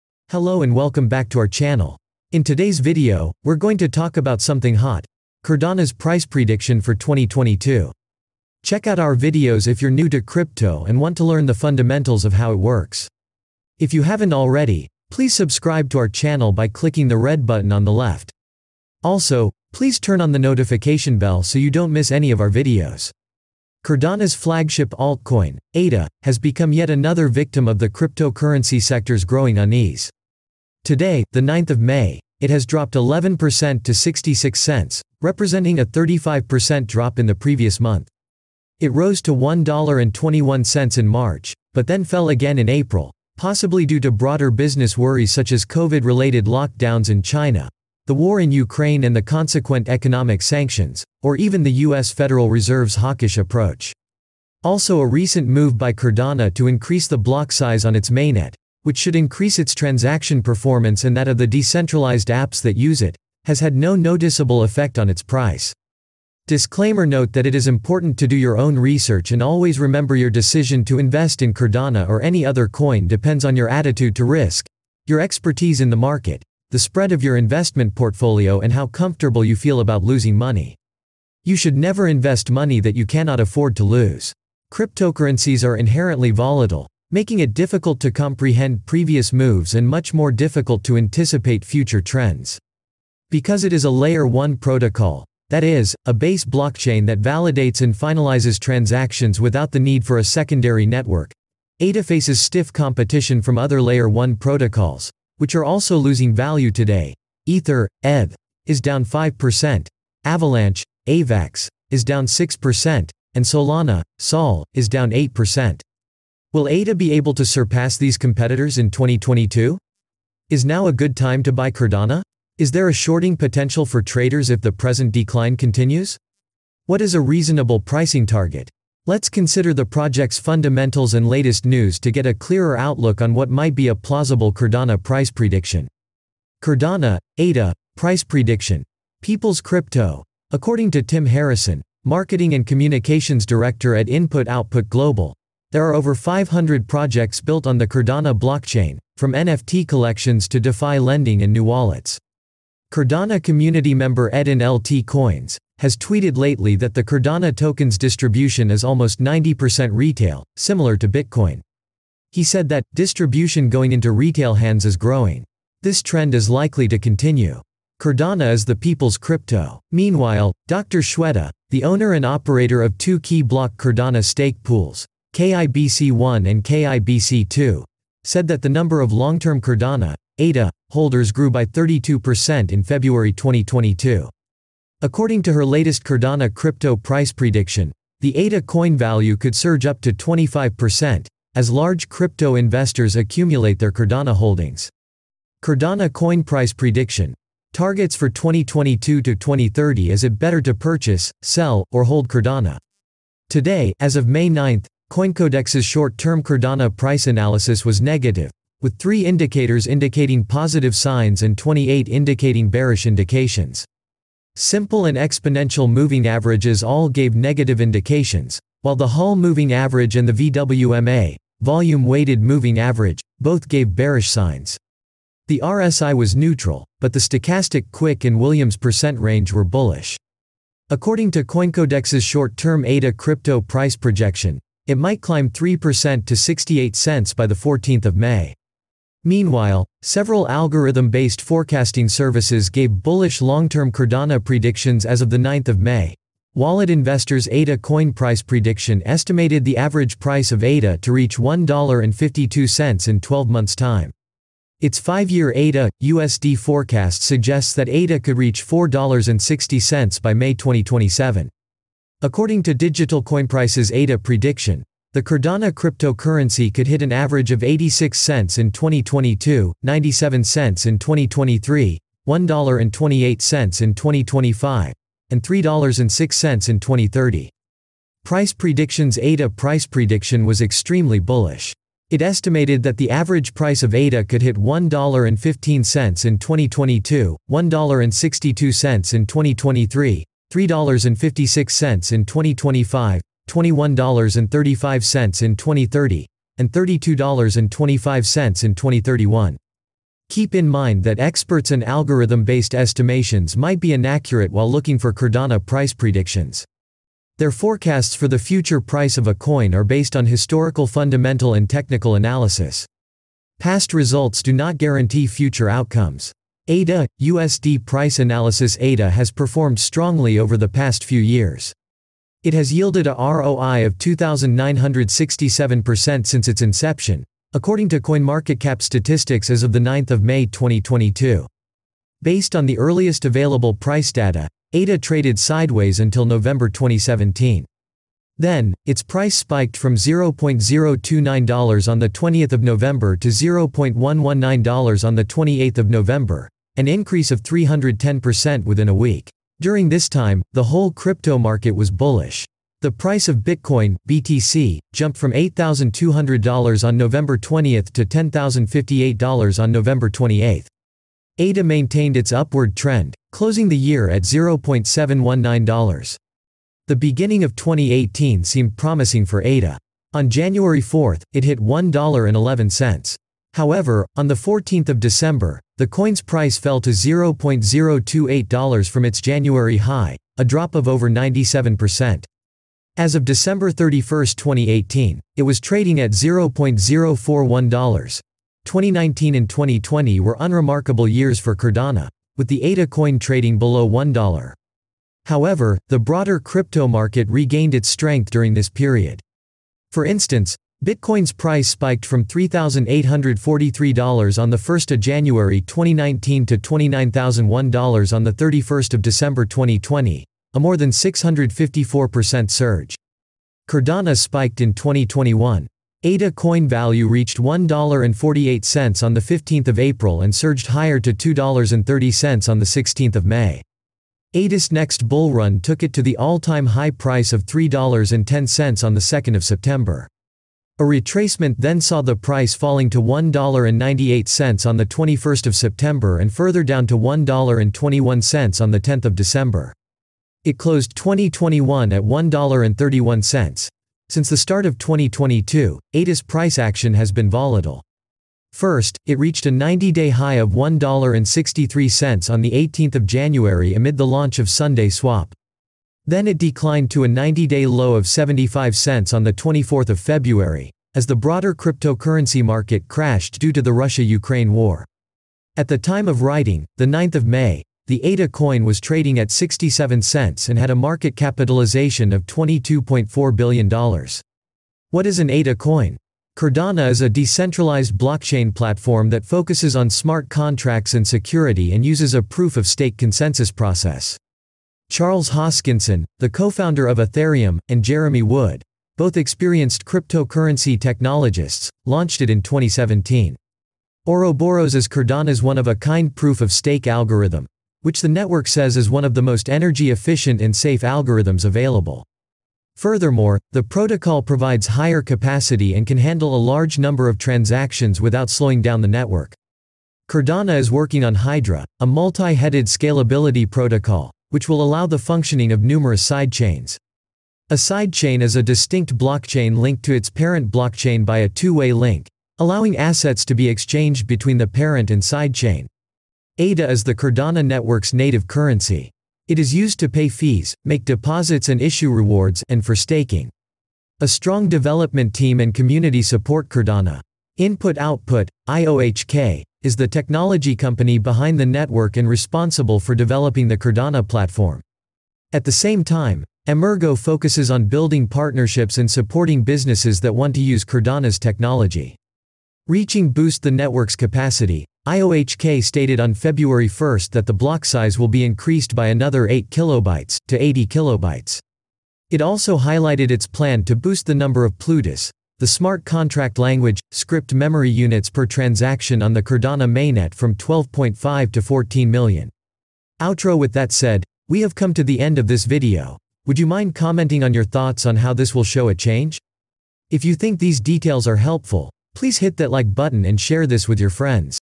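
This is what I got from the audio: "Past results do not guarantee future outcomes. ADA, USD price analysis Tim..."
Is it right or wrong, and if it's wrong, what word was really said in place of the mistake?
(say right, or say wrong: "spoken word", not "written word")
wrong: "ADA", not "Tim".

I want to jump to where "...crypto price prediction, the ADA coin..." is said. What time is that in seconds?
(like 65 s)
186 s.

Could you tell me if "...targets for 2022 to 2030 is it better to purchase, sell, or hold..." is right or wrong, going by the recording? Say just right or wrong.
right.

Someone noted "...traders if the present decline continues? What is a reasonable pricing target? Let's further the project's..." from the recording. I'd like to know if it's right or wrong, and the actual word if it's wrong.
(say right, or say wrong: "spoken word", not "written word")
wrong: "consider", not "further".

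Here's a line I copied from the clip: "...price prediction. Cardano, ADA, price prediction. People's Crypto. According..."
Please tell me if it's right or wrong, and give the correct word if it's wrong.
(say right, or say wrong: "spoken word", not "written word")
right.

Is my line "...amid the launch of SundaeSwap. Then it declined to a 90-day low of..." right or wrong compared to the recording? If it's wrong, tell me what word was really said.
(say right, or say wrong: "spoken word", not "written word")
right.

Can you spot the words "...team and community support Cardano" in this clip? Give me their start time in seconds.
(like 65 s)
535 s.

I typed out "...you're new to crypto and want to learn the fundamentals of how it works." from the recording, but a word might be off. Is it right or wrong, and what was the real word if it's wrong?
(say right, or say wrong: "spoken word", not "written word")
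right.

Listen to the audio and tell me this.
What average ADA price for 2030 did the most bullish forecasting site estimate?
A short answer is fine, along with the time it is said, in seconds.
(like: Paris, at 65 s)
$21.35, at 293 s.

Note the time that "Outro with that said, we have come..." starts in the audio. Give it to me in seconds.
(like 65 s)
573 s.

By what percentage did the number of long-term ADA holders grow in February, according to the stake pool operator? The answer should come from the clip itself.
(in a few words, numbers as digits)
32%.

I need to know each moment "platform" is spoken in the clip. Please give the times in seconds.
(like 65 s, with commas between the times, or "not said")
478 s, 544 s.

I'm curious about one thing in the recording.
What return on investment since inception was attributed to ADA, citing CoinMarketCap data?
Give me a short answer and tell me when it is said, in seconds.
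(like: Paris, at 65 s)
2,967%, at 323 s.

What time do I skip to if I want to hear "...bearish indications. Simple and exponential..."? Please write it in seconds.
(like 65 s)
212 s.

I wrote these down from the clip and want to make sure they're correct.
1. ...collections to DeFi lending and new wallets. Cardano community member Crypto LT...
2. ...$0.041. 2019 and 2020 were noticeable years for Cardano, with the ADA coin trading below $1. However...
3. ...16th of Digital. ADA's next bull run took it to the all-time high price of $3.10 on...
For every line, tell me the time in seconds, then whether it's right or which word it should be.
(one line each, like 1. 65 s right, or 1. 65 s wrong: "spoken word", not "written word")
1. 149 s wrong: "Edin", not "Crypto"
2. 386 s wrong: "unremarkable", not "noticeable"
3. 422 s wrong: "May", not "Digital".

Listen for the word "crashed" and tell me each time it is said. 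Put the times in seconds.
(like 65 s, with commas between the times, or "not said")
462 s.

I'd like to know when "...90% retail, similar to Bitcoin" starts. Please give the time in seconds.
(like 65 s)
159 s.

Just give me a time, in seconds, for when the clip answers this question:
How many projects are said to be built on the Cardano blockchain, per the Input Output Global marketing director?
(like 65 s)
145 s.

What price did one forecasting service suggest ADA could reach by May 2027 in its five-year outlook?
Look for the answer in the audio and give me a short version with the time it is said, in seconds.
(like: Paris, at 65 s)
$4.60, at 258 s.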